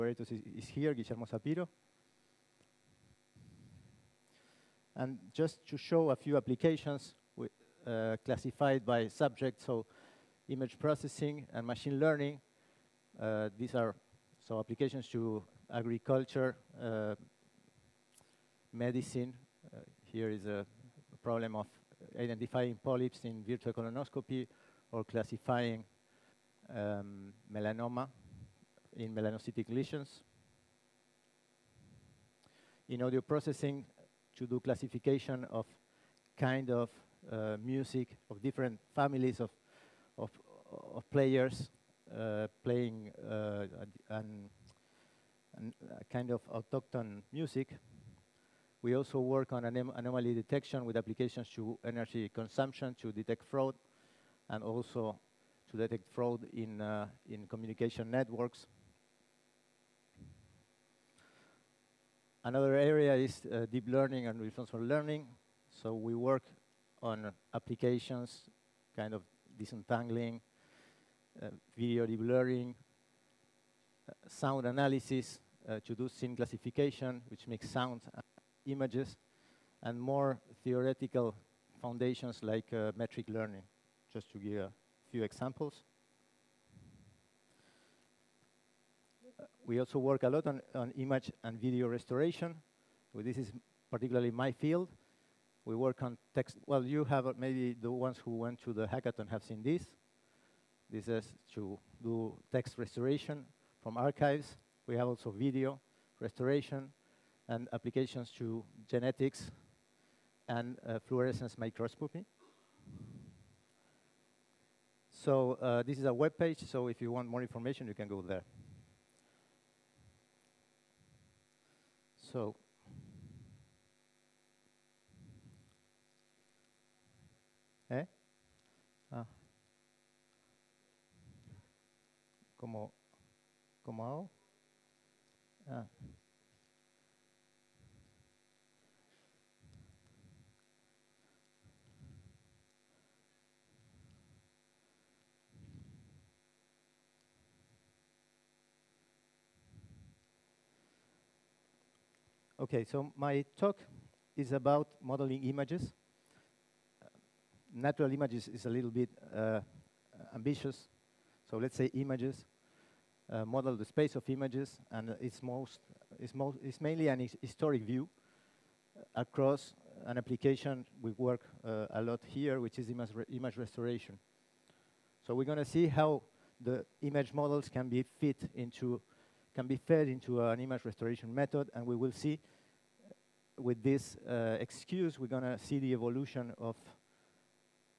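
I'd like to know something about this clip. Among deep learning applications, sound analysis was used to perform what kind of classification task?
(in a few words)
Scene classification.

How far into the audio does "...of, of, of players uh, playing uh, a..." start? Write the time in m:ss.
0:39.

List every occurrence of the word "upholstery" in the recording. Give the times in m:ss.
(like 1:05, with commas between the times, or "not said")
not said.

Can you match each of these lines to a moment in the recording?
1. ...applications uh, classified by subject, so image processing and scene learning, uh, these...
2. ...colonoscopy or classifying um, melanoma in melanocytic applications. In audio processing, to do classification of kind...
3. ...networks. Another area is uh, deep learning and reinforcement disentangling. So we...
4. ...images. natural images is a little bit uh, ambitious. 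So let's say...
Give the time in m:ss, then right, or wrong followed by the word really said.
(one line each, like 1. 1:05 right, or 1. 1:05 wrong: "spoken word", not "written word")
1. 0:06 wrong: "machine", not "scene"
2. 0:23 wrong: "lesions", not "applications"
3. 0:58 wrong: "learning", not "disentangling"
4. 2:35 right.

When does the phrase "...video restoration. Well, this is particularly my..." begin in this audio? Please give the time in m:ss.
1:31.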